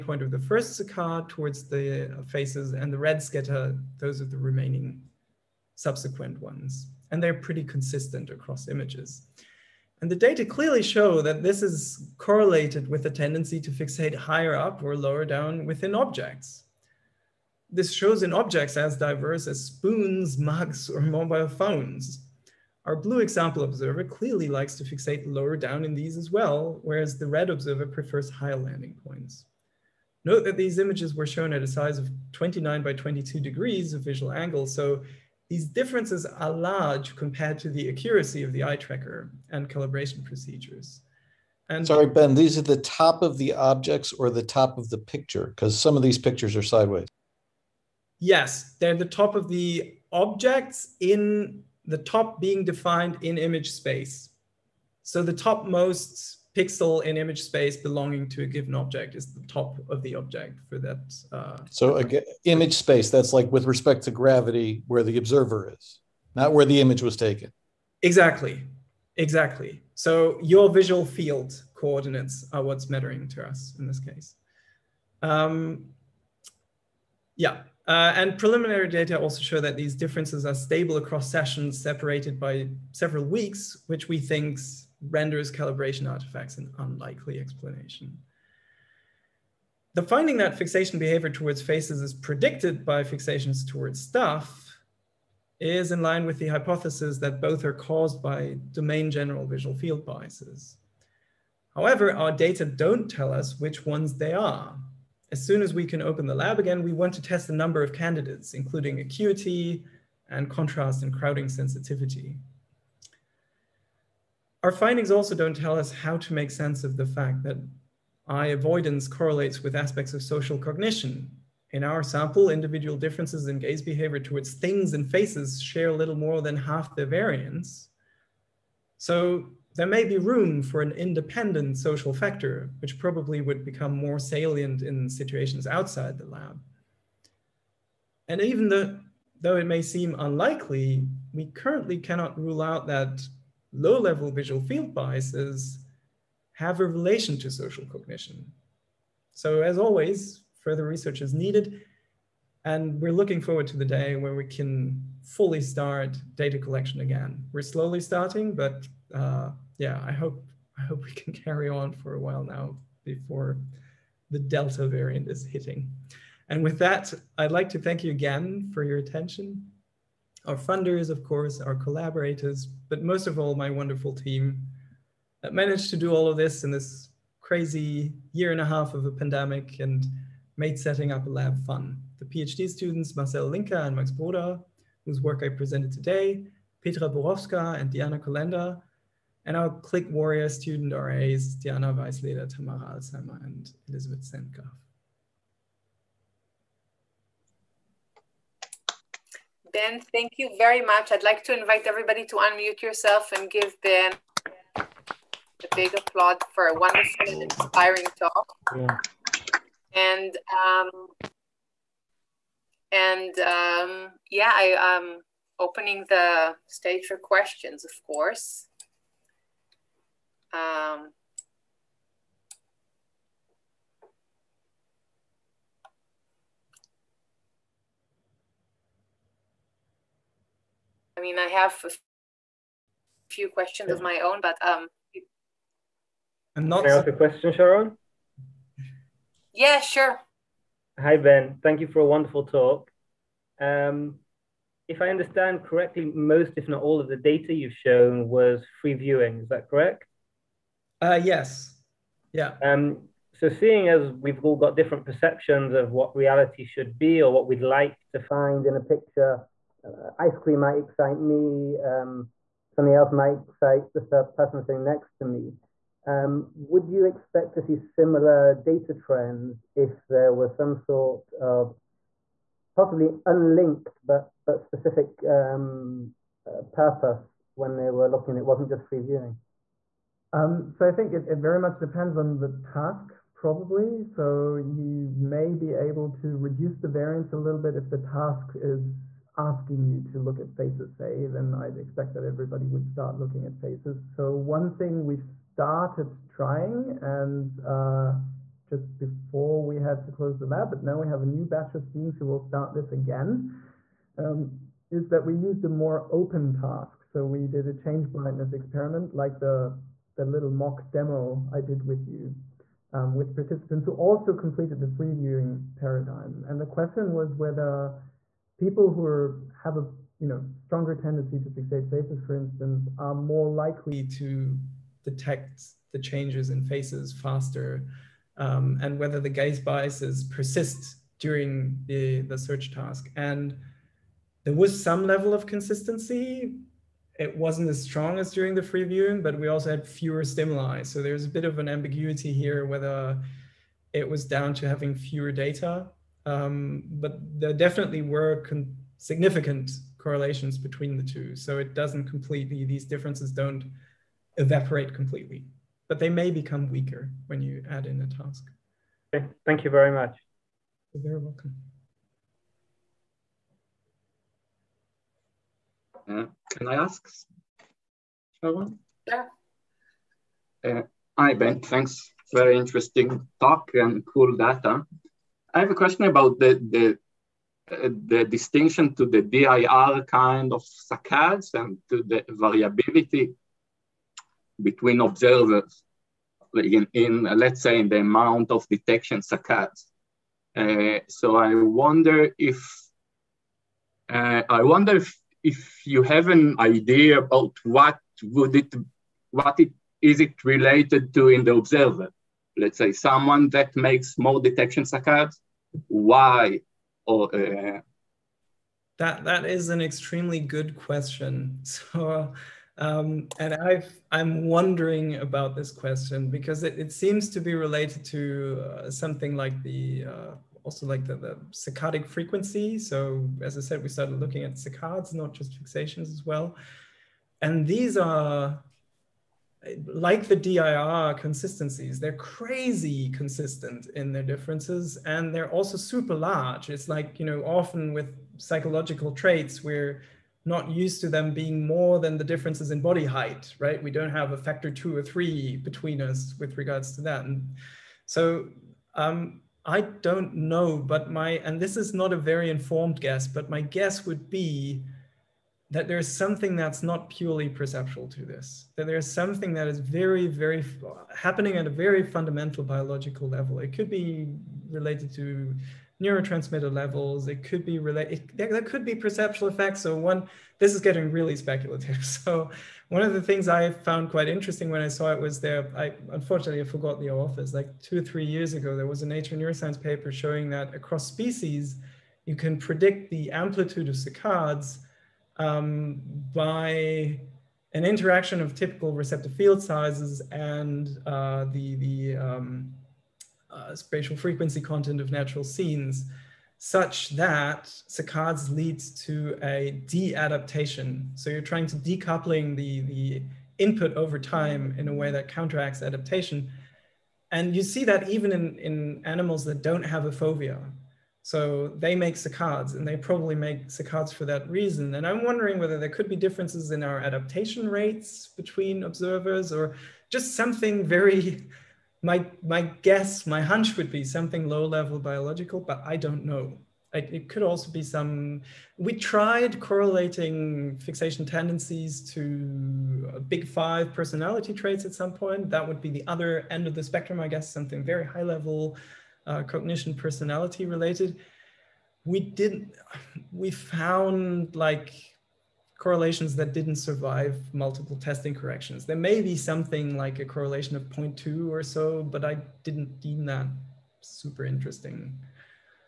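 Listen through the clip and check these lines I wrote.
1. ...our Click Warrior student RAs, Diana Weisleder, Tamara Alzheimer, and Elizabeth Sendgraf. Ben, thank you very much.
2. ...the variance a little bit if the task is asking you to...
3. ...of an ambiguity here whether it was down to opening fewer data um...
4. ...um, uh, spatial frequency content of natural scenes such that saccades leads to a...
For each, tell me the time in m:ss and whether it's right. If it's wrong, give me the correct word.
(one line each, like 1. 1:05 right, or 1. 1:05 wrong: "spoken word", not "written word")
1. 3:09 right
2. 4:46 right
3. 5:41 wrong: "having", not "opening"
4. 8:12 right.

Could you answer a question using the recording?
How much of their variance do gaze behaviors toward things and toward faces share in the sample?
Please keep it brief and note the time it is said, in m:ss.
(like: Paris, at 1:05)
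little more than half, at 2:05.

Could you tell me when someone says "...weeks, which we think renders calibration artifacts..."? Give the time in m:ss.
1:23.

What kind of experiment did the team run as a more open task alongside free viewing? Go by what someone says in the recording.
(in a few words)
change blindness.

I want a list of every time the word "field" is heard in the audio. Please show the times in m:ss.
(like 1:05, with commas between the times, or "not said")
1:11, 1:39, 2:24, 8:09.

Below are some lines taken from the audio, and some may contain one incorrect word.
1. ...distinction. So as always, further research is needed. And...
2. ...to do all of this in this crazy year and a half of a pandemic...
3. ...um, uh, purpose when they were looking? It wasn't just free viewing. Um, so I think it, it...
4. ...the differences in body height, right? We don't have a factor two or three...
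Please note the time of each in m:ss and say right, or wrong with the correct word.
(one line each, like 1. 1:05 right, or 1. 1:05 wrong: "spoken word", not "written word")
1. 2:27 wrong: "cognition", not "distinction"
2. 2:55 right
3. 4:35 right
4. 7:22 right.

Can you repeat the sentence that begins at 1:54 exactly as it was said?
Our findings also don't tell us how to make sense of the fact that eye avoidance correlates with aspects of social cognition.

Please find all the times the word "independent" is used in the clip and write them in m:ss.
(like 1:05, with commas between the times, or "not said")
2:10.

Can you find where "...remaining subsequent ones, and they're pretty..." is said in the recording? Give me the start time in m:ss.
0:04.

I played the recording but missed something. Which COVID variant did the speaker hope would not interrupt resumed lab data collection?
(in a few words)
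Delta.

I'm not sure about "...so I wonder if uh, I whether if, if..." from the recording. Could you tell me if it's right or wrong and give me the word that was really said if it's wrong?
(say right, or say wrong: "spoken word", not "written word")
wrong: "wonder", not "whether".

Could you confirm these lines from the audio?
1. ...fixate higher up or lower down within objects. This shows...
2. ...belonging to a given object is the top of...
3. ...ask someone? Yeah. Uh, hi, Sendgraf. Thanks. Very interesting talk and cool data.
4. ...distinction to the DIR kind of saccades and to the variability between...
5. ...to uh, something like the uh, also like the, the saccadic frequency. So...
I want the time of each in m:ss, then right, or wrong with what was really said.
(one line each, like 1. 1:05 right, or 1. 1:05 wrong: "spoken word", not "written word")
1. 0:13 right
2. 0:57 right
3. 6:06 wrong: "Ben", not "Sendgraf"
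4. 6:18 right
5. 6:58 right.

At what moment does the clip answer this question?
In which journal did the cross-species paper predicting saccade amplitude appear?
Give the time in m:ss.
7:59.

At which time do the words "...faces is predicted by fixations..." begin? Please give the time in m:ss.
1:31.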